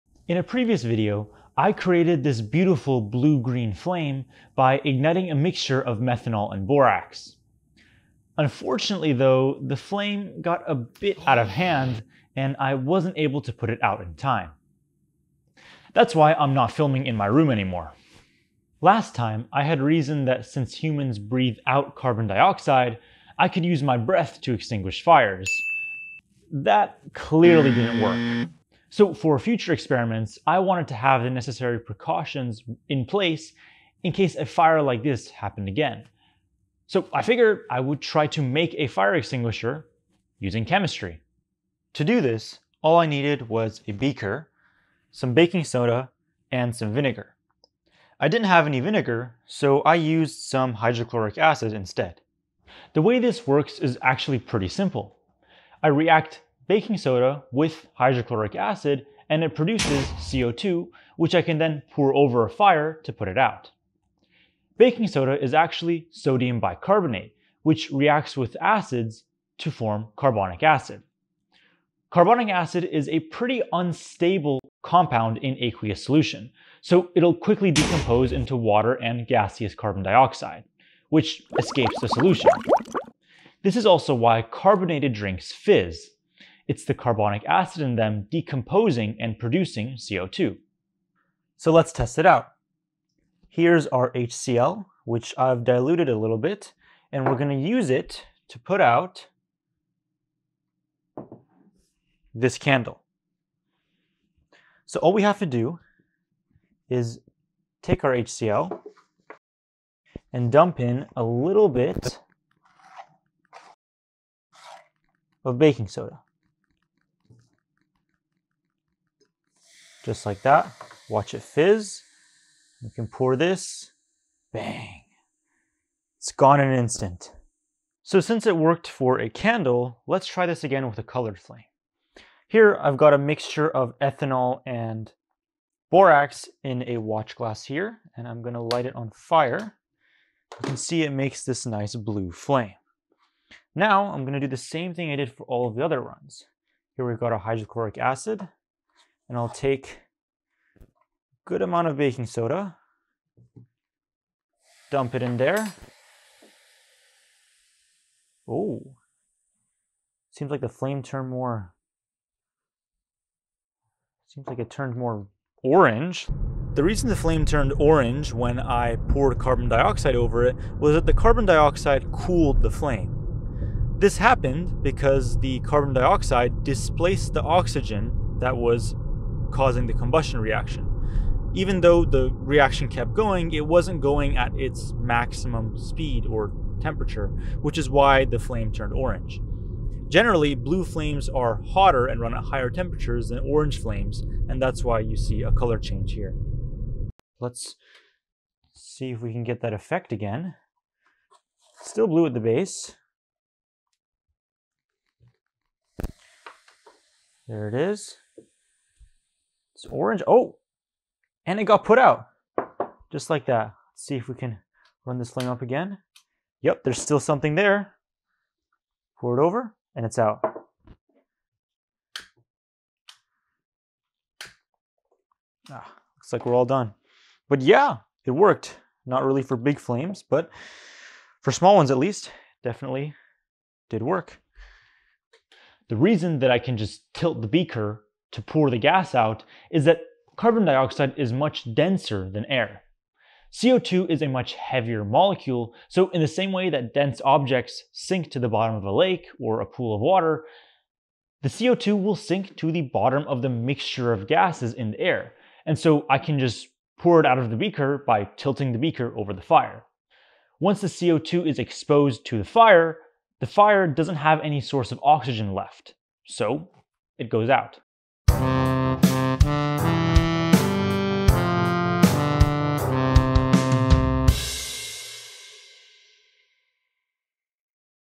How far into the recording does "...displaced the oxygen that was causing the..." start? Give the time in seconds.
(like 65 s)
176 s.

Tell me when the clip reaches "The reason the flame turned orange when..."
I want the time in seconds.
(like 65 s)
166 s.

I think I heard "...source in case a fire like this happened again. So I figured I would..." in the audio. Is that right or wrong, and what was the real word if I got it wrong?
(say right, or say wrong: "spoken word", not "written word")
wrong: "place", not "source".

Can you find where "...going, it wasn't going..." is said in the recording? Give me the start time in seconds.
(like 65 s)
183 s.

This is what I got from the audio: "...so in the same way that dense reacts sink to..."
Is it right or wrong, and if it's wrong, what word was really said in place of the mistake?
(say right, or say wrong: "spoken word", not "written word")
wrong: "objects", not "reacts".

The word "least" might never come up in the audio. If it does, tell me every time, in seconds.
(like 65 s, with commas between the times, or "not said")
231 s.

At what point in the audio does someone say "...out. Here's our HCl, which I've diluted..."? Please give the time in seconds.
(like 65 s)
92 s.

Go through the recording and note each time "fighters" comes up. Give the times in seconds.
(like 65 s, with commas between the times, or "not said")
not said.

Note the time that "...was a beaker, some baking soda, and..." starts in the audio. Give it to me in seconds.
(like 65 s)
43 s.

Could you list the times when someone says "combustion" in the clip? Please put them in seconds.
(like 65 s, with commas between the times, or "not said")
179 s.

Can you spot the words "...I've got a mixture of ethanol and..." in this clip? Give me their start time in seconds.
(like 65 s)
132 s.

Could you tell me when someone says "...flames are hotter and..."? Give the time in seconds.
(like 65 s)
190 s.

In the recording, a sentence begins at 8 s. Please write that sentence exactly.
Unfortunately though, the flame got a bit out of hand and I wasn't able to put it out in time.